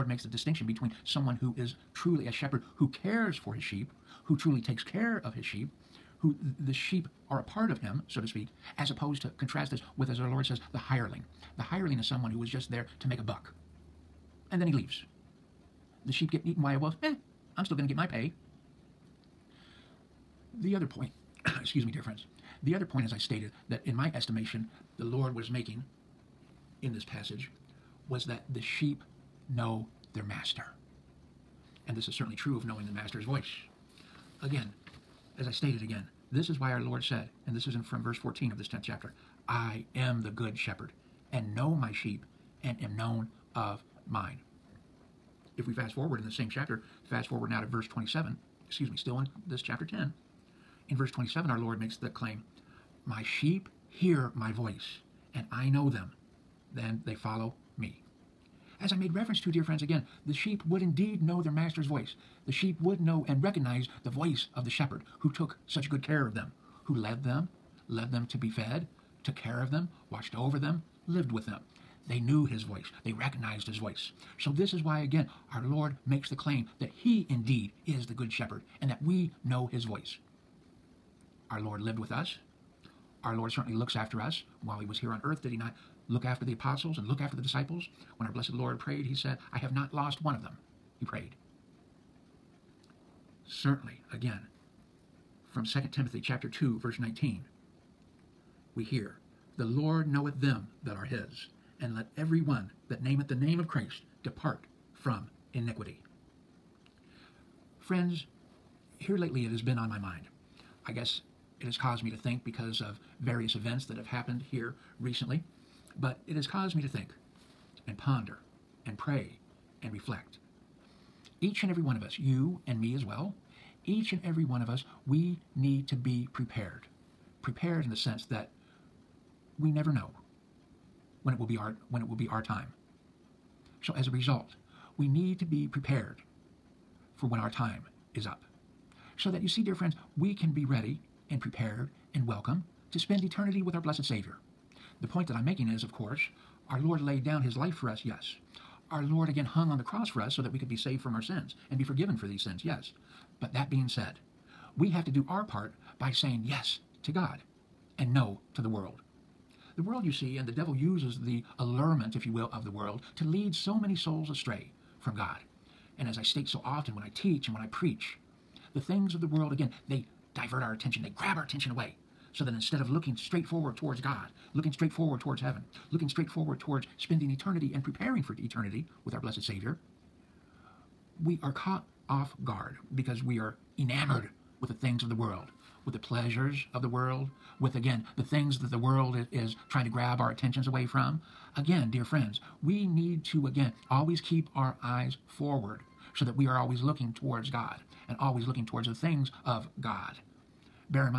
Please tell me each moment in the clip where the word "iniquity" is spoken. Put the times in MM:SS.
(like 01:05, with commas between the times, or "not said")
01:45.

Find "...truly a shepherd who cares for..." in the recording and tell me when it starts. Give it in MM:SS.
00:01.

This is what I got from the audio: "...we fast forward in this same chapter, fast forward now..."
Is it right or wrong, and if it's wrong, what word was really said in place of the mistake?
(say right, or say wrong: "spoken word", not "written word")
right.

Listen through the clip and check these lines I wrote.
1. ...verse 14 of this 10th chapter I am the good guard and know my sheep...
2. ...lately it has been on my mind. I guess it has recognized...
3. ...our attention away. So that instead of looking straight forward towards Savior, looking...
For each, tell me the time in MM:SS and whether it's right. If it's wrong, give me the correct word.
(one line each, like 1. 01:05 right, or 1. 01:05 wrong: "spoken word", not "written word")
1. 00:38 wrong: "shepherd", not "guard"
2. 01:49 wrong: "caused", not "recognized"
3. 02:51 wrong: "God", not "Savior".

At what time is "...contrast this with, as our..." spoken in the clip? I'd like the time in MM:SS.
00:09.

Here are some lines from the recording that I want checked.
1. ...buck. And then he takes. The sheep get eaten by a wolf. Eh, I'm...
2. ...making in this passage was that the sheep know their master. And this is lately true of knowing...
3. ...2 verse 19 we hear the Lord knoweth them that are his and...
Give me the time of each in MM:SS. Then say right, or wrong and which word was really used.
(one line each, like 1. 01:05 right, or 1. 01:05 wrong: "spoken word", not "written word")
1. 00:13 wrong: "leaves", not "takes"
2. 00:25 wrong: "certainly", not "lately"
3. 01:36 right.